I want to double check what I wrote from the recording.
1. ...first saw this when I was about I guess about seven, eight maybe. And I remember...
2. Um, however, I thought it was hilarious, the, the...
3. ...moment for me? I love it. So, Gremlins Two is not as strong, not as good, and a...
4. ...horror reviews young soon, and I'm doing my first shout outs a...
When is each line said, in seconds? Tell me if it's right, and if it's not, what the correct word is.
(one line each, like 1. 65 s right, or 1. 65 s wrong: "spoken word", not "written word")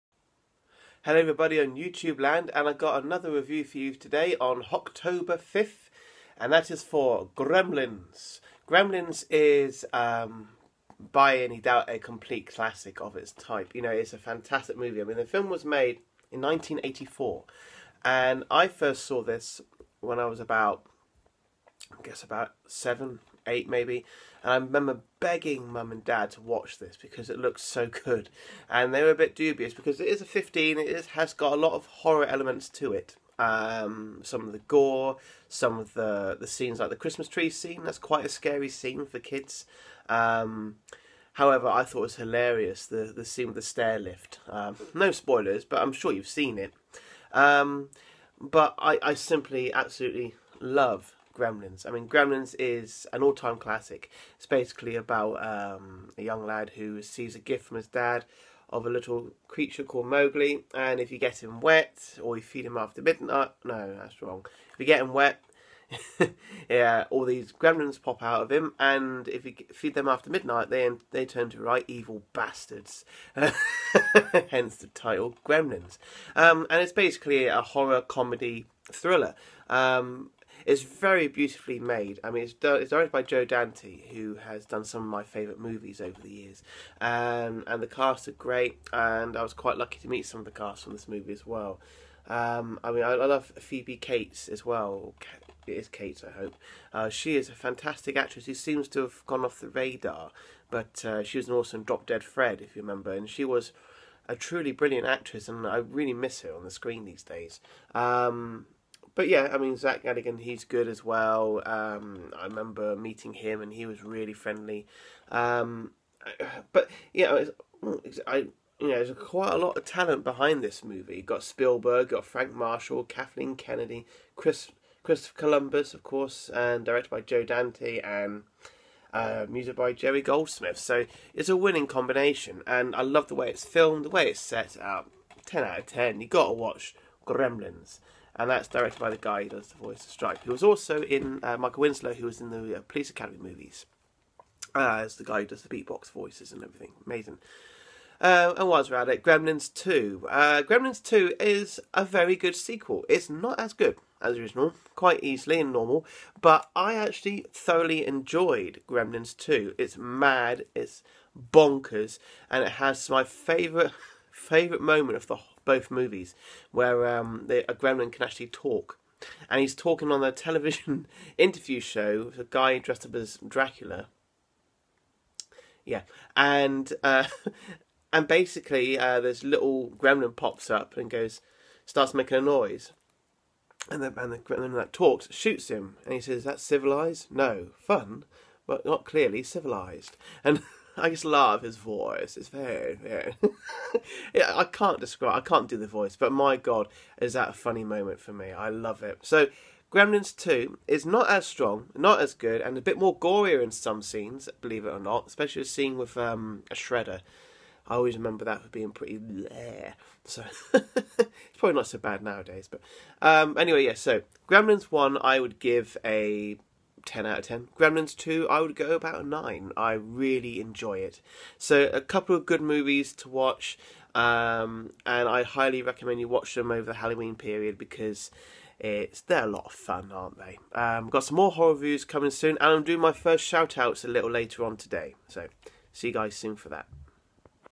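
1. 18 s right
2. 40 s right
3. 197 s right
4. 231 s wrong: "coming", not "young".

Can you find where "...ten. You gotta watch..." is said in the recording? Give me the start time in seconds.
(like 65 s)
135 s.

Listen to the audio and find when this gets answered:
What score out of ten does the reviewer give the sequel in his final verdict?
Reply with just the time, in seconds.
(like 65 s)
219 s.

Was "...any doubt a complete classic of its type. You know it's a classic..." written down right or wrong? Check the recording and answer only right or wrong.
wrong.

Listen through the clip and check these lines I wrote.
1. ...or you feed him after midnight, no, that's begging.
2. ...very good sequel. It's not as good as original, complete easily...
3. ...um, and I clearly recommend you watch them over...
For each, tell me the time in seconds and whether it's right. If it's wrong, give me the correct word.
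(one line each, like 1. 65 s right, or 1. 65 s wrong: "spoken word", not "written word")
1. 62 s wrong: "wrong", not "begging"
2. 152 s wrong: "quite", not "complete"
3. 224 s wrong: "highly", not "clearly".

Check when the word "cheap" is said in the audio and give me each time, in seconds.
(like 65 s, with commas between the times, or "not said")
not said.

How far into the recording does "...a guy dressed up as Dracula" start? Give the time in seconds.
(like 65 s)
172 s.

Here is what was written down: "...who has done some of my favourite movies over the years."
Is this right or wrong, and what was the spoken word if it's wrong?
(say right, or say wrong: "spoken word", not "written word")
right.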